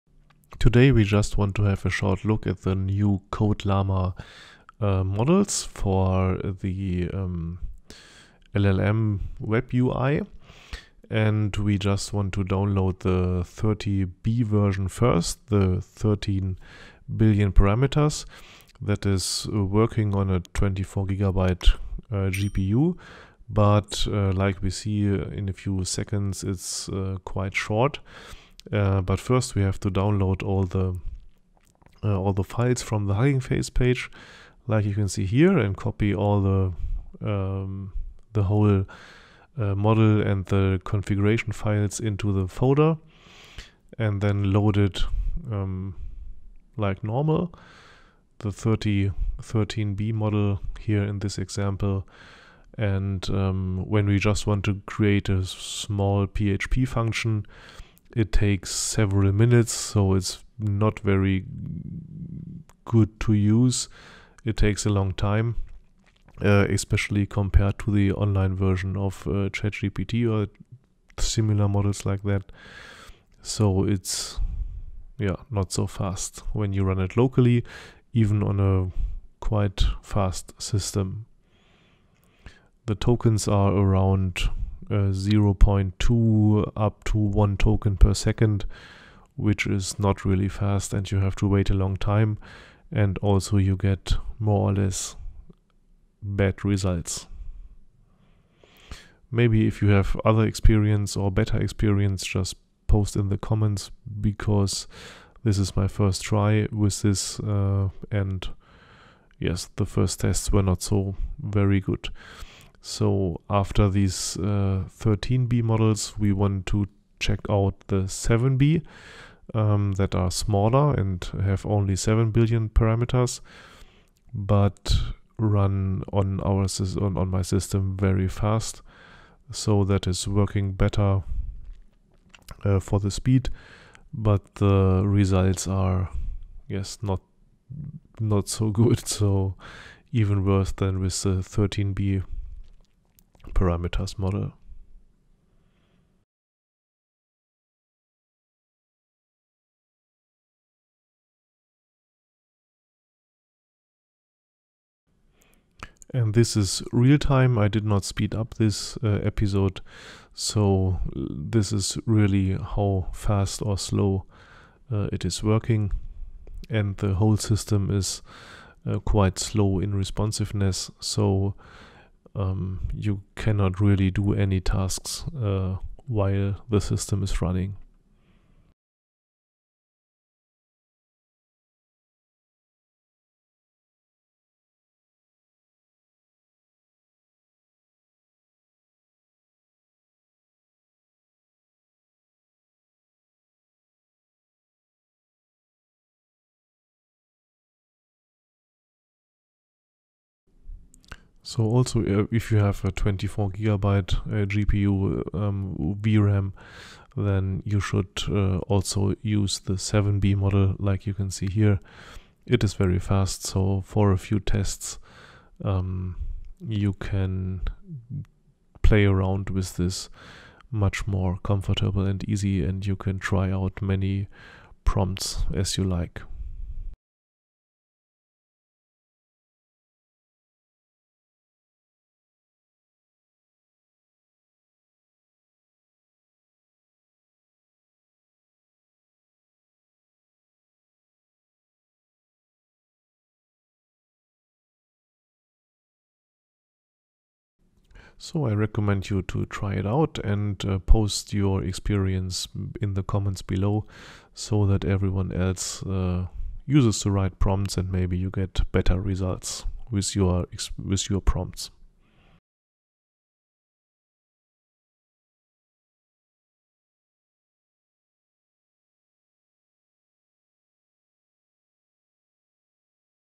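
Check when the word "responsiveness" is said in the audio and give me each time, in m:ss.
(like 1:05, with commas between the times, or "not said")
2:49.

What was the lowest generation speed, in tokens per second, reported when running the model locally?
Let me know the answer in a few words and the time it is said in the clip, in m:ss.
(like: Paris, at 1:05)
0.2, at 1:25.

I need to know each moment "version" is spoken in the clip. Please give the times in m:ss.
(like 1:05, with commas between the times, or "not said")
0:14, 1:08.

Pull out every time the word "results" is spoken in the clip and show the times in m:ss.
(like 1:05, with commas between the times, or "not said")
1:36, 2:15, 4:19.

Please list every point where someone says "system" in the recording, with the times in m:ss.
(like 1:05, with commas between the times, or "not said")
1:20, 2:07, 2:47, 2:56.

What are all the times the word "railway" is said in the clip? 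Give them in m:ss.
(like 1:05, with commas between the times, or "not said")
not said.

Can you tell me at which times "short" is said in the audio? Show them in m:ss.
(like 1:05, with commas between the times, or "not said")
0:01, 0:27.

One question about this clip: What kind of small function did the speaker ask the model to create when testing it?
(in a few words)
PHP function.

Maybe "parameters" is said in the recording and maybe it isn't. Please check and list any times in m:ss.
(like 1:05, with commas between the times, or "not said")
0:17, 2:02, 2:23.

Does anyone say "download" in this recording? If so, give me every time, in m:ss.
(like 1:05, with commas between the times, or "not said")
0:12, 0:29.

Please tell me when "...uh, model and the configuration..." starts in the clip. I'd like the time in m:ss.
0:39.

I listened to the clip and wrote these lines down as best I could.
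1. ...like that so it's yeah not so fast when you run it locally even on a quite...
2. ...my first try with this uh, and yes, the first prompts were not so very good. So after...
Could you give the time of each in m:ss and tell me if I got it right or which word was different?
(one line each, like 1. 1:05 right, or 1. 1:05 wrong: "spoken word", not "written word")
1. 1:12 right
2. 1:45 wrong: "tests", not "prompts".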